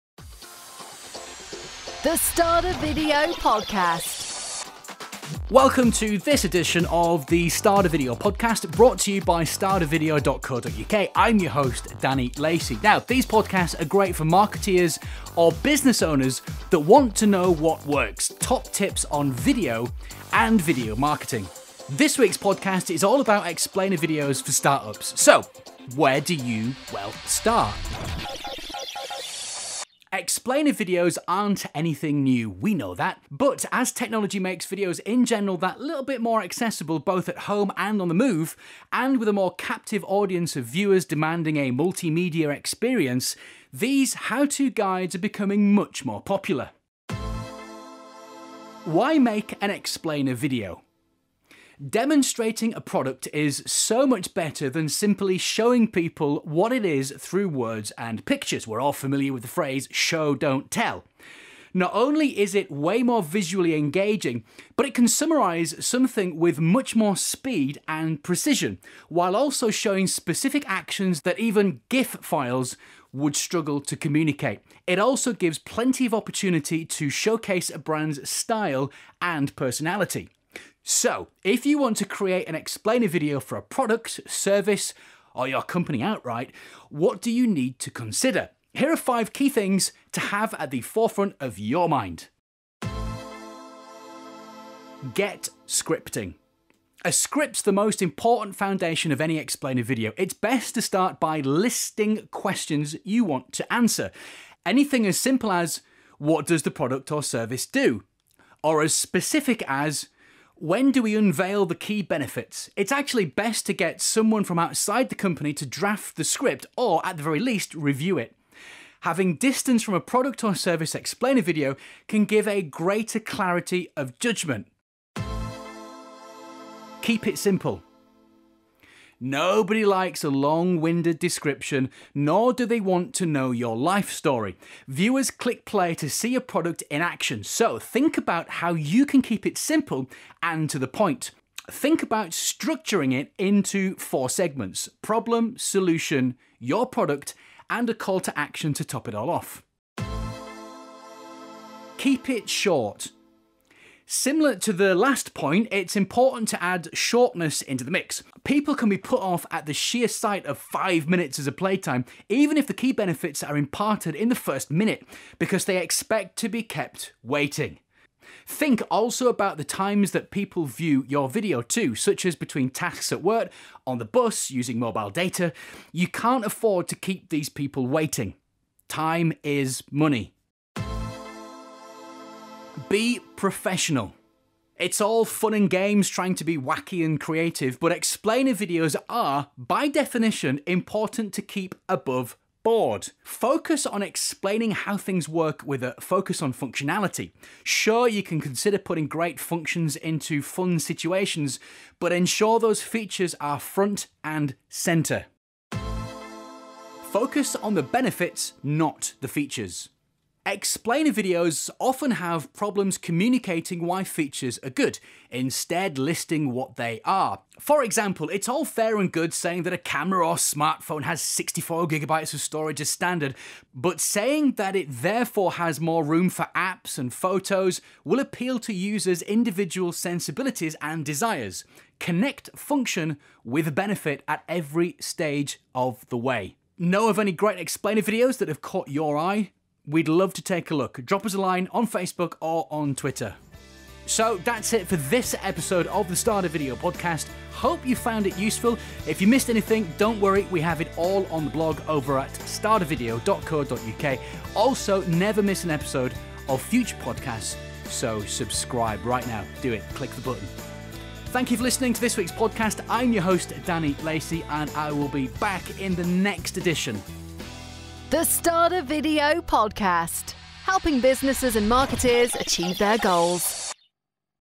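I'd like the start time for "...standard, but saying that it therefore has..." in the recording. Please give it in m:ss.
3:42.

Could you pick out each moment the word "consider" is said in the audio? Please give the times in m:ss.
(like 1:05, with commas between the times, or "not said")
1:27, 3:18.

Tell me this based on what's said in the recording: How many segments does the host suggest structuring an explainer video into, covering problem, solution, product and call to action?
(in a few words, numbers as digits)
4.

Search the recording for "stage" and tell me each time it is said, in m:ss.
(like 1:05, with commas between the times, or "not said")
3:54.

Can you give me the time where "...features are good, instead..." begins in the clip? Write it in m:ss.
3:34.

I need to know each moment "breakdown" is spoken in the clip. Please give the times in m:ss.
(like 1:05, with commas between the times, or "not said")
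not said.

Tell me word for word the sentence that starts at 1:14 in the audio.
It also gives plenty of opportunity to showcase a brand's style and personality.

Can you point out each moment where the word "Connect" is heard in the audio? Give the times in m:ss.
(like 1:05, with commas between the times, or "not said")
3:51.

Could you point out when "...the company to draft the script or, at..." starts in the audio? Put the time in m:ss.
1:55.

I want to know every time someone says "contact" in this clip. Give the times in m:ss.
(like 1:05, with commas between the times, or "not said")
not said.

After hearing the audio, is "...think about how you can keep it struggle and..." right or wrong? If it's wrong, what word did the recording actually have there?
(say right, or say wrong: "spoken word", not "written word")
wrong: "simple", not "struggle".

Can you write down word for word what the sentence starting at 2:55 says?
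You can't afford to keep these people waiting.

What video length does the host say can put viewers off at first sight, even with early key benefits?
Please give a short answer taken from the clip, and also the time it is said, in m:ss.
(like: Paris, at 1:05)
5 minutes, at 2:40.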